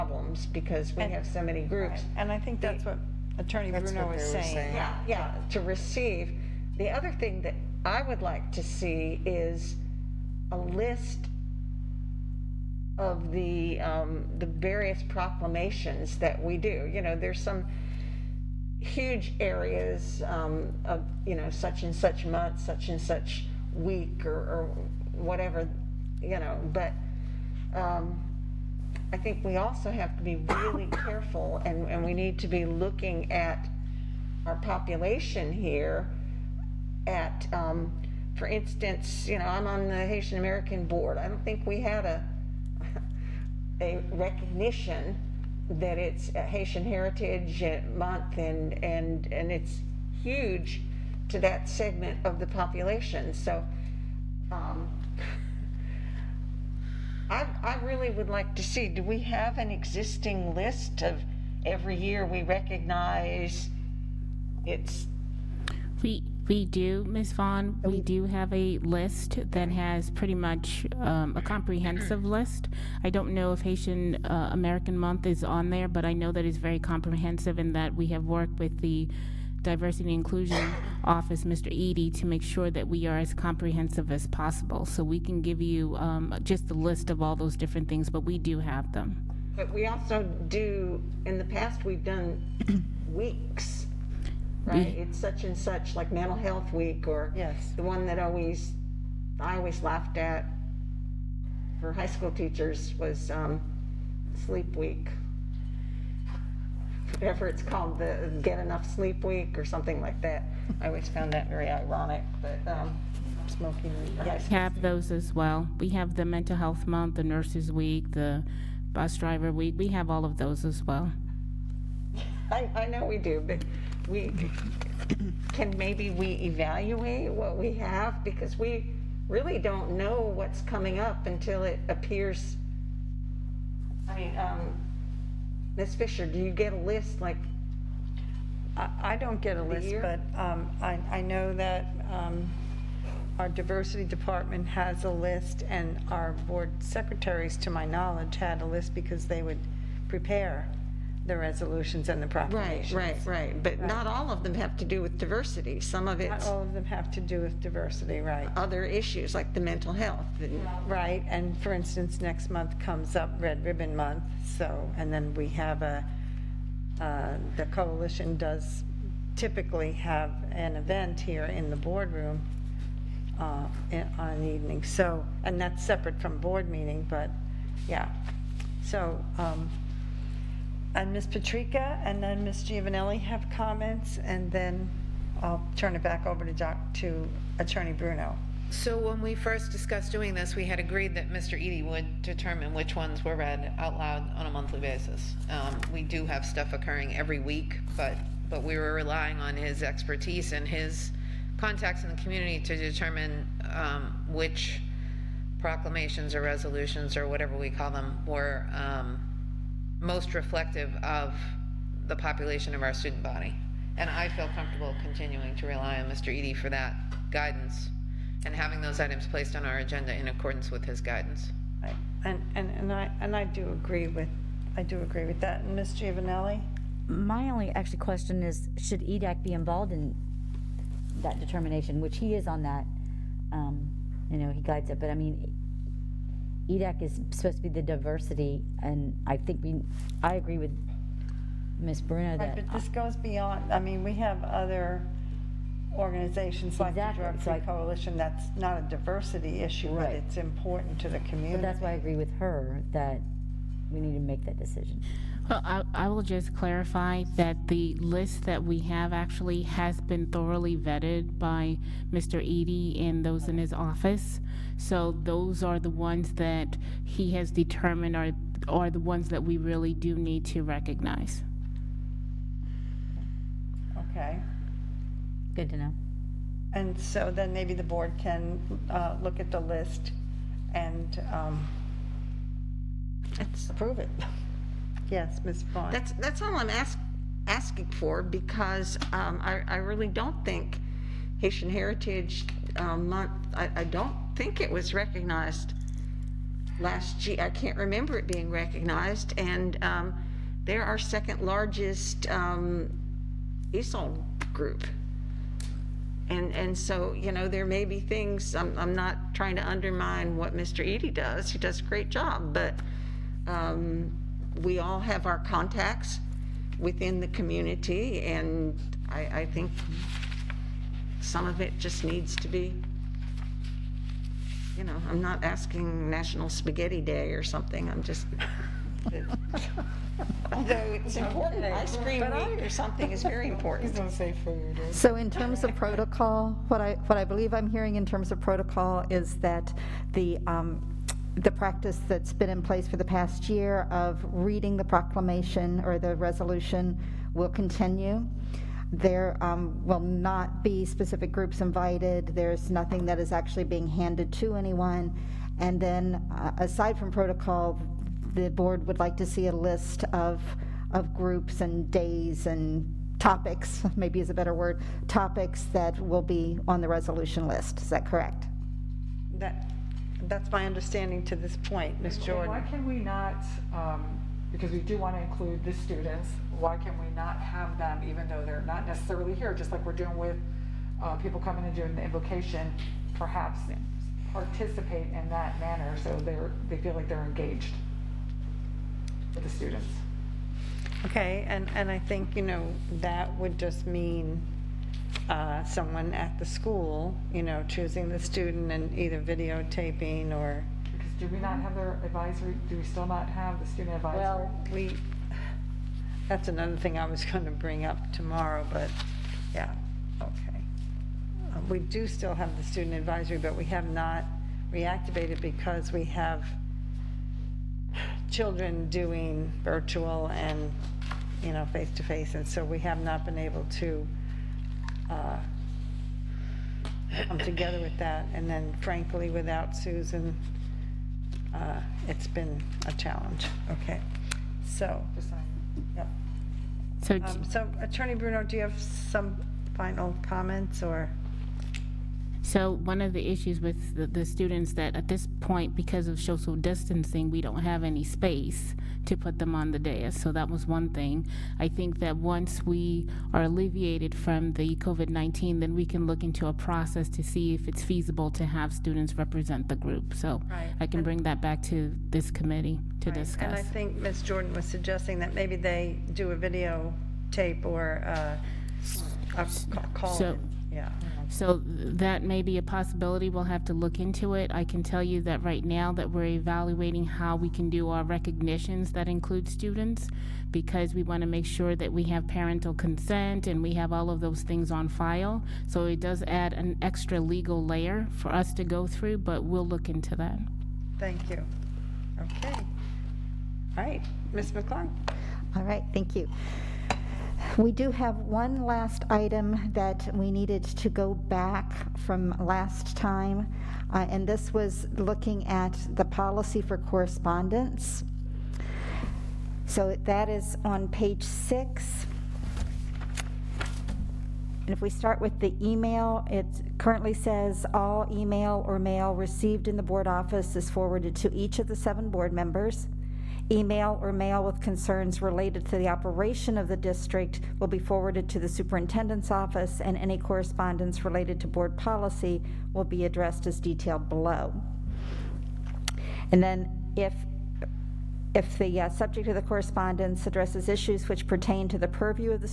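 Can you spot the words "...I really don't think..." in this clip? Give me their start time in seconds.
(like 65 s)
289 s.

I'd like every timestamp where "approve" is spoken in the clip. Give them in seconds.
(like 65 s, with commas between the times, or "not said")
283 s.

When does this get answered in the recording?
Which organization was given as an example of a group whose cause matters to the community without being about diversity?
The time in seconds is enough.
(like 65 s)
247 s.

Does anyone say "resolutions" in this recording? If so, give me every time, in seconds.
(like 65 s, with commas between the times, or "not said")
151 s, 206 s, 346 s, 366 s.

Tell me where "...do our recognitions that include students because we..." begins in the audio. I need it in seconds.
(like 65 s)
477 s.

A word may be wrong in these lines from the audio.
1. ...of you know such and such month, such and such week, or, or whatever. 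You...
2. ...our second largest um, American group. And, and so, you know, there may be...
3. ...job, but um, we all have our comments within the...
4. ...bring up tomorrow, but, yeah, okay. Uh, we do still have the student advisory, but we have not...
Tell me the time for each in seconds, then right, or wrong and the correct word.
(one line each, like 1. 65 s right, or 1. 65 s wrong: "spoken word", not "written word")
1. 20 s right
2. 300 s wrong: "ESOL", not "American"
3. 312 s wrong: "contacts", not "comments"
4. 407 s right.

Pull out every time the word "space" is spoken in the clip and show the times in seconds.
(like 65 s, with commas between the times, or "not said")
448 s.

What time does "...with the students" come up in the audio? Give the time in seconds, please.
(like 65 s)
389 s.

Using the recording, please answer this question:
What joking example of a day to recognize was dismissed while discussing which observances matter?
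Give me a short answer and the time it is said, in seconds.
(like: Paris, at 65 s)
National Spaghetti Day, at 326 s.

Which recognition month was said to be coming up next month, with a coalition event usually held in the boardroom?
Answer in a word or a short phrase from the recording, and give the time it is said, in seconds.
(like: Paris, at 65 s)
Red Ribbon Month, at 163 s.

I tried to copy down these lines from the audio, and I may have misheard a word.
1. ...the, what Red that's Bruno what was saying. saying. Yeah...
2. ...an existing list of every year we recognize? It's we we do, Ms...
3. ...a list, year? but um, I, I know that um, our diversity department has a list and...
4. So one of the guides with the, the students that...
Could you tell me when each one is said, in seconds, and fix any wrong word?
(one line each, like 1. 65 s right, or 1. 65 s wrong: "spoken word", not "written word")
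1. 2 s wrong: "Attorney", not "Red"
2. 59 s right
3. 139 s right
4. 442 s wrong: "issues", not "guides".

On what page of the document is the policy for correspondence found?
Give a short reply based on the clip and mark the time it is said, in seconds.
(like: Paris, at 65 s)
6, at 510 s.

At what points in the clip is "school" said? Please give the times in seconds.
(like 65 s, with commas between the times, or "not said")
102 s, 396 s.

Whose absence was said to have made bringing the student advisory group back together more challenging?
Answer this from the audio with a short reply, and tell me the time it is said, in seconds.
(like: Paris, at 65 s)
Susan, at 429 s.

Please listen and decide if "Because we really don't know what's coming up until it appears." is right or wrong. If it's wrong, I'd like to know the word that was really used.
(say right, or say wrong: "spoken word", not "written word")
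right.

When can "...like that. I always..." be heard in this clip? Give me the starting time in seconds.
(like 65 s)
109 s.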